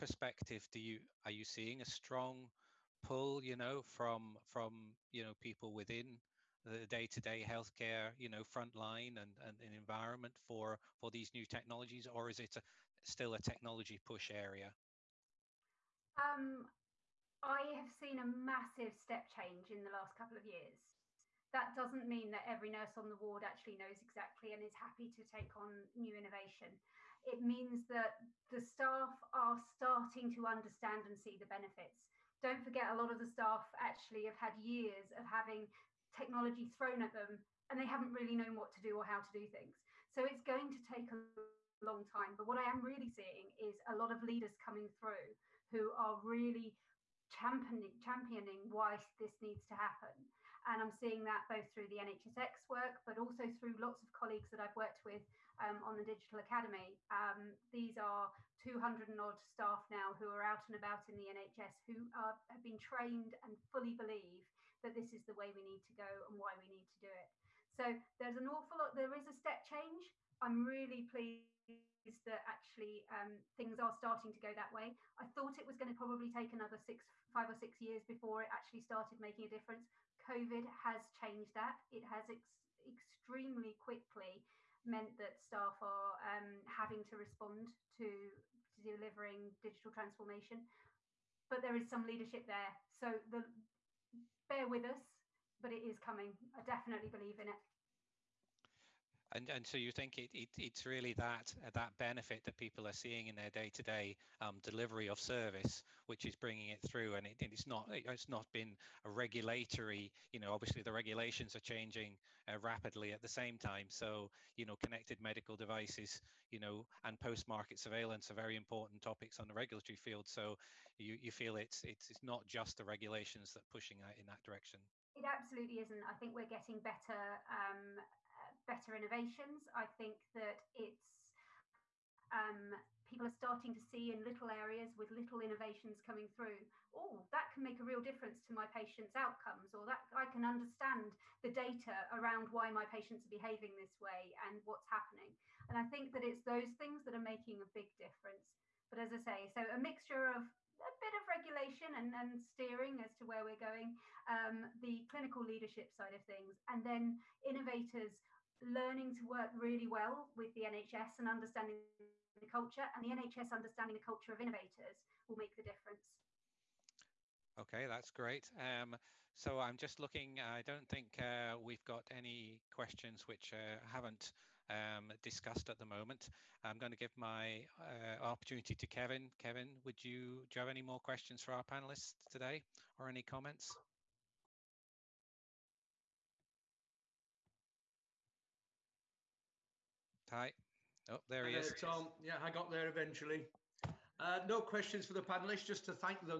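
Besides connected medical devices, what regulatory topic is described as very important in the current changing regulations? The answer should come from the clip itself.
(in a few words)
Post market surveillance.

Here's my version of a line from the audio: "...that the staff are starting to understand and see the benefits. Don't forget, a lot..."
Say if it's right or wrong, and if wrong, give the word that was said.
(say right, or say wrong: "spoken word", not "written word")
right.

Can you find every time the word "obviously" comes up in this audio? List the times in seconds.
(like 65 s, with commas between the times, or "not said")
110 s.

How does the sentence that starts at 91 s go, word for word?
But there is some leadership there.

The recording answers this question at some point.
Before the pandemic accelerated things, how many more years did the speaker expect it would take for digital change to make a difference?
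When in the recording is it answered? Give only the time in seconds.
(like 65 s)
77 s.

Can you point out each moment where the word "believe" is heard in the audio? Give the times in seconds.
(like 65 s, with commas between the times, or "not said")
63 s, 97 s.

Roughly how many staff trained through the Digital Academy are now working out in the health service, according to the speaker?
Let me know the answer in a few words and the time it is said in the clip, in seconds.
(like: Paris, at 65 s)
200, at 58 s.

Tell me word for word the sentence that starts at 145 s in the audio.
And I think that it's those things that are making a big difference.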